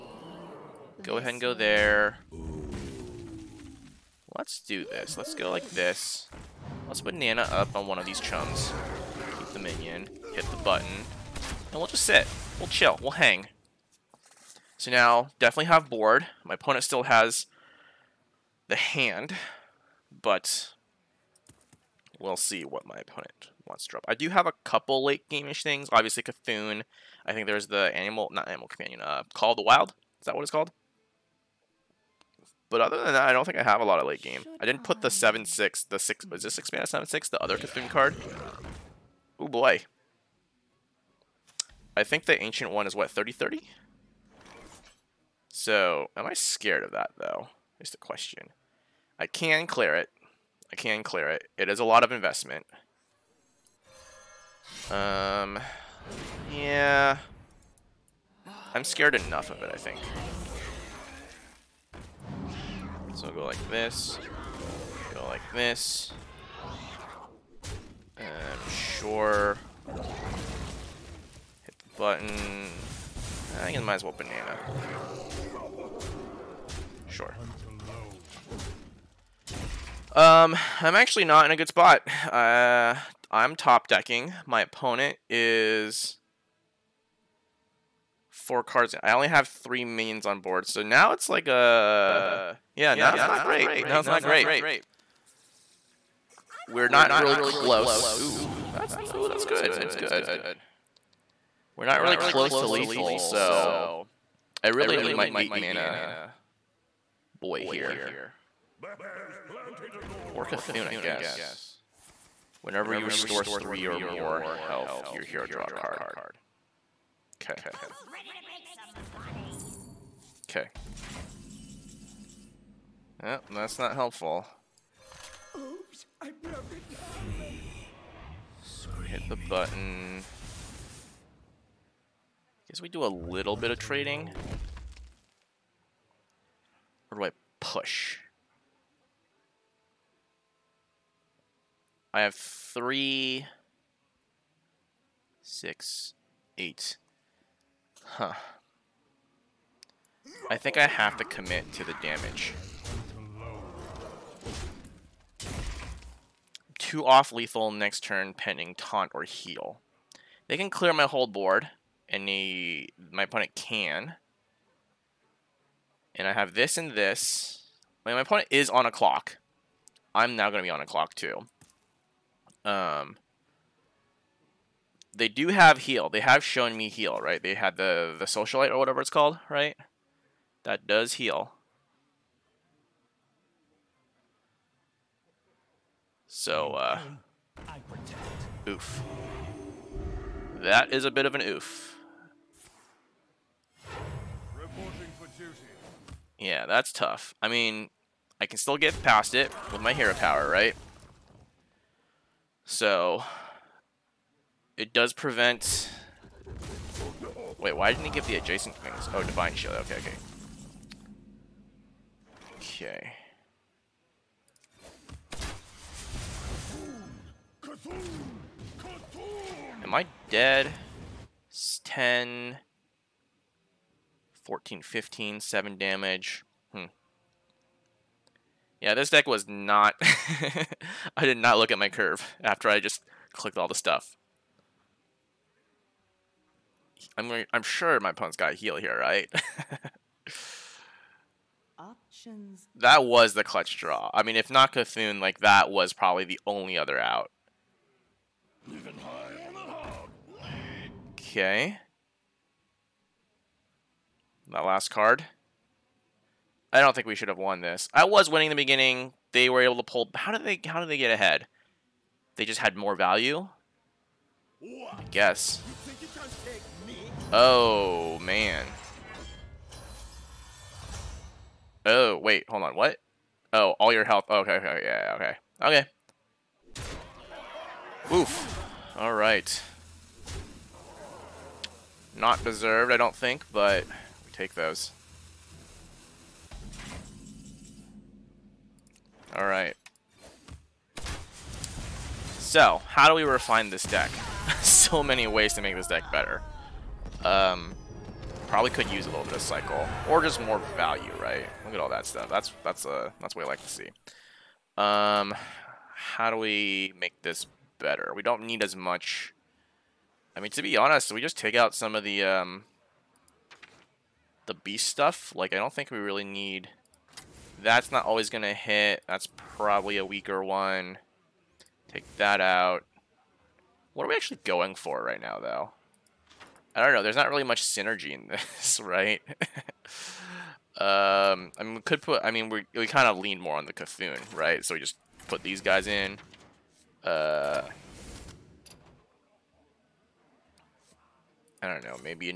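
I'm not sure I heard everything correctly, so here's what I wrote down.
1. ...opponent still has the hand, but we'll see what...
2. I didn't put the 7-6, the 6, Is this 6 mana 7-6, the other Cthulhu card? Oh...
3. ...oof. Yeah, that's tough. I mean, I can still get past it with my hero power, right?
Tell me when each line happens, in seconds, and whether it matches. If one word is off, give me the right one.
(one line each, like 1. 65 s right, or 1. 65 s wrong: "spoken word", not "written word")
1. 16 s right
2. 34 s right
3. 191 s right.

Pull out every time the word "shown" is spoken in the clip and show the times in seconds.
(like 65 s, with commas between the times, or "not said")
176 s.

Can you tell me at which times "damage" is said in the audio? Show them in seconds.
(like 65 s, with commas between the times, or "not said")
152 s, 225 s.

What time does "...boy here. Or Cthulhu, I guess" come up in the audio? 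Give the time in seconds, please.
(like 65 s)
107 s.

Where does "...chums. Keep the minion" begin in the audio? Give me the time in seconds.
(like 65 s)
8 s.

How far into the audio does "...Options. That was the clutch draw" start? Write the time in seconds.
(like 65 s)
241 s.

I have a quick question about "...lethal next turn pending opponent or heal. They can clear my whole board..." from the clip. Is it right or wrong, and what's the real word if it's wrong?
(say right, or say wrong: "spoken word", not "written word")
wrong: "taunt", not "opponent".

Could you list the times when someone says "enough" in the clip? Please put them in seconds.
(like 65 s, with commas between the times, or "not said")
59 s.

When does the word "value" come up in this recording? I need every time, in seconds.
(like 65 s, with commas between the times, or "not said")
262 s, 300 s.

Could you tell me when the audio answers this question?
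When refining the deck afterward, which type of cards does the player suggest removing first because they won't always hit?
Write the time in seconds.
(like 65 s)
314 s.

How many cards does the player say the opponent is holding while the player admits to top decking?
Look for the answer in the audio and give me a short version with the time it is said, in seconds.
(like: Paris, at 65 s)
4, at 88 s.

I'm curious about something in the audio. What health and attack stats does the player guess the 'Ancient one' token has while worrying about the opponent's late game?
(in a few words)
30-30.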